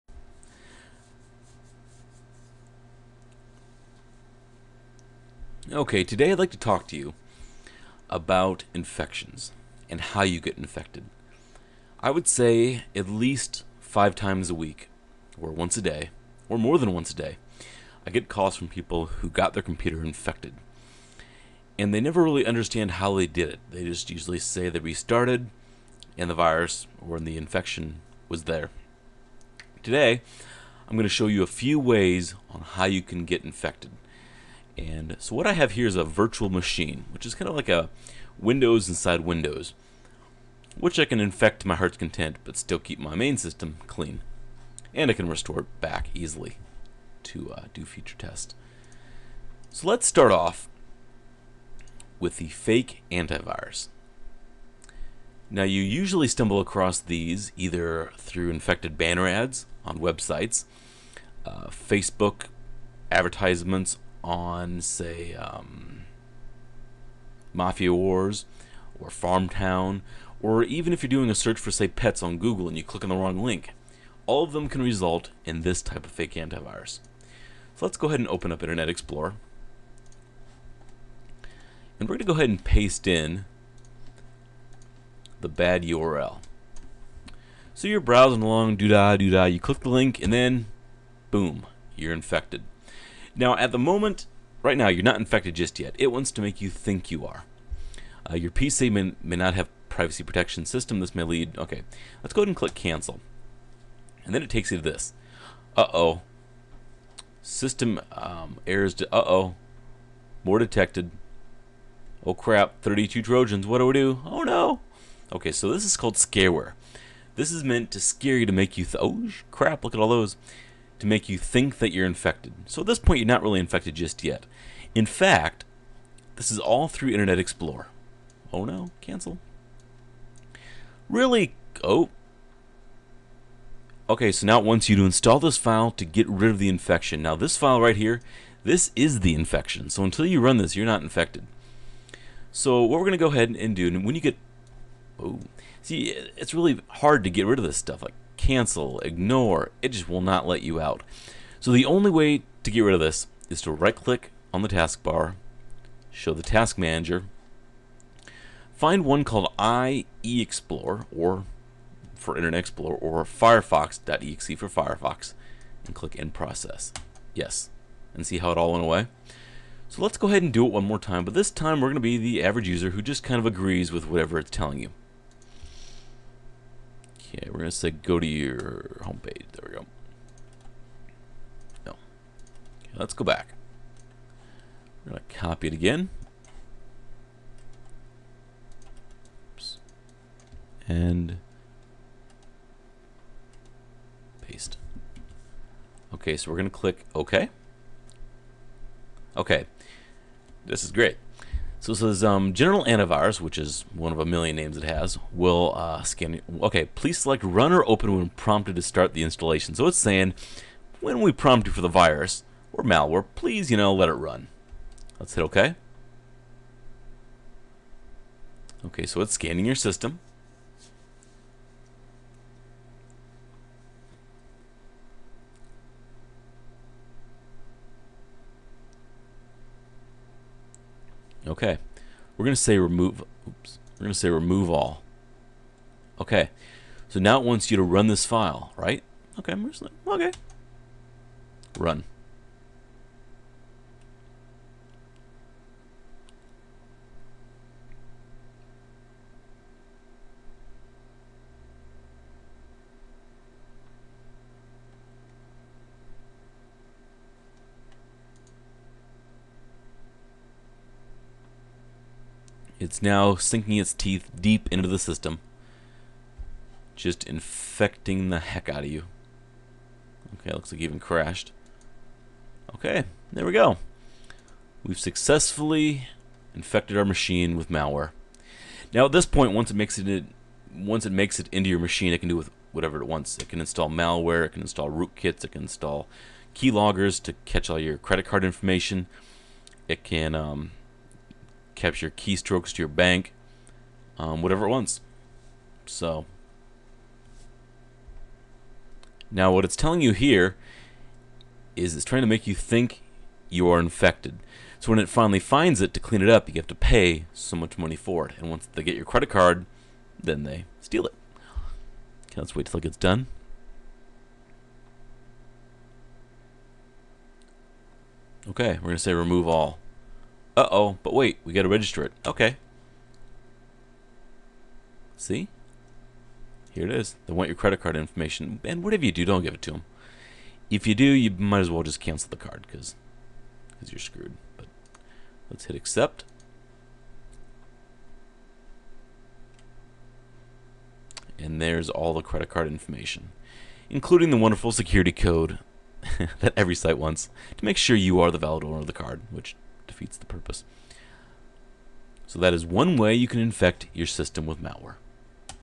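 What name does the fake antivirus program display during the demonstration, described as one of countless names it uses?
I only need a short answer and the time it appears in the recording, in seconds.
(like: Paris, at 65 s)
General Antivirus, at 202 s.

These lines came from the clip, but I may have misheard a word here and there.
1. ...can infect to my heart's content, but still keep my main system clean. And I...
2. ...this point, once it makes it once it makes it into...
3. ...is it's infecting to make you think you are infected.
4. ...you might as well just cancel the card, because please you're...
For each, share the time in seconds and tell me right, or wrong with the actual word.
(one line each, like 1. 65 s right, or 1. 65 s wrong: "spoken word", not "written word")
1. 41 s right
2. 279 s right
3. 301 s wrong: "trying", not "infecting"
4. 331 s wrong: "cause", not "please".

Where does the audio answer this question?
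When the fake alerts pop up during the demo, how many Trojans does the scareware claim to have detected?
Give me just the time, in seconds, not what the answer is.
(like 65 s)
112 s.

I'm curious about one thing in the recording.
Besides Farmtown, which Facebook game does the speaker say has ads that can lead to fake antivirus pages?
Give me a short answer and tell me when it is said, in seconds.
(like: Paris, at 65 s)
Mafia Wars, at 67 s.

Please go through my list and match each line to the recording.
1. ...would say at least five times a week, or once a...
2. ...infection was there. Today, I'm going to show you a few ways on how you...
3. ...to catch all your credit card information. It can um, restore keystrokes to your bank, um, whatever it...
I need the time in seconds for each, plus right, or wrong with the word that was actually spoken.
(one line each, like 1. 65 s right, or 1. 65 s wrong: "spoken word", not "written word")
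1. 12 s right
2. 27 s right
3. 287 s wrong: "capture", not "restore".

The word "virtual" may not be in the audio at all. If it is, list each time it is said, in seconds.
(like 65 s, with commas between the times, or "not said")
36 s.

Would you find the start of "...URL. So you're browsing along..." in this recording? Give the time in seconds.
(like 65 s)
85 s.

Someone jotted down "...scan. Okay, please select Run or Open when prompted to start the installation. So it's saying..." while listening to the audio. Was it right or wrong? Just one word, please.
right.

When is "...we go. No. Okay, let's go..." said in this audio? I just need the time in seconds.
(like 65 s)
179 s.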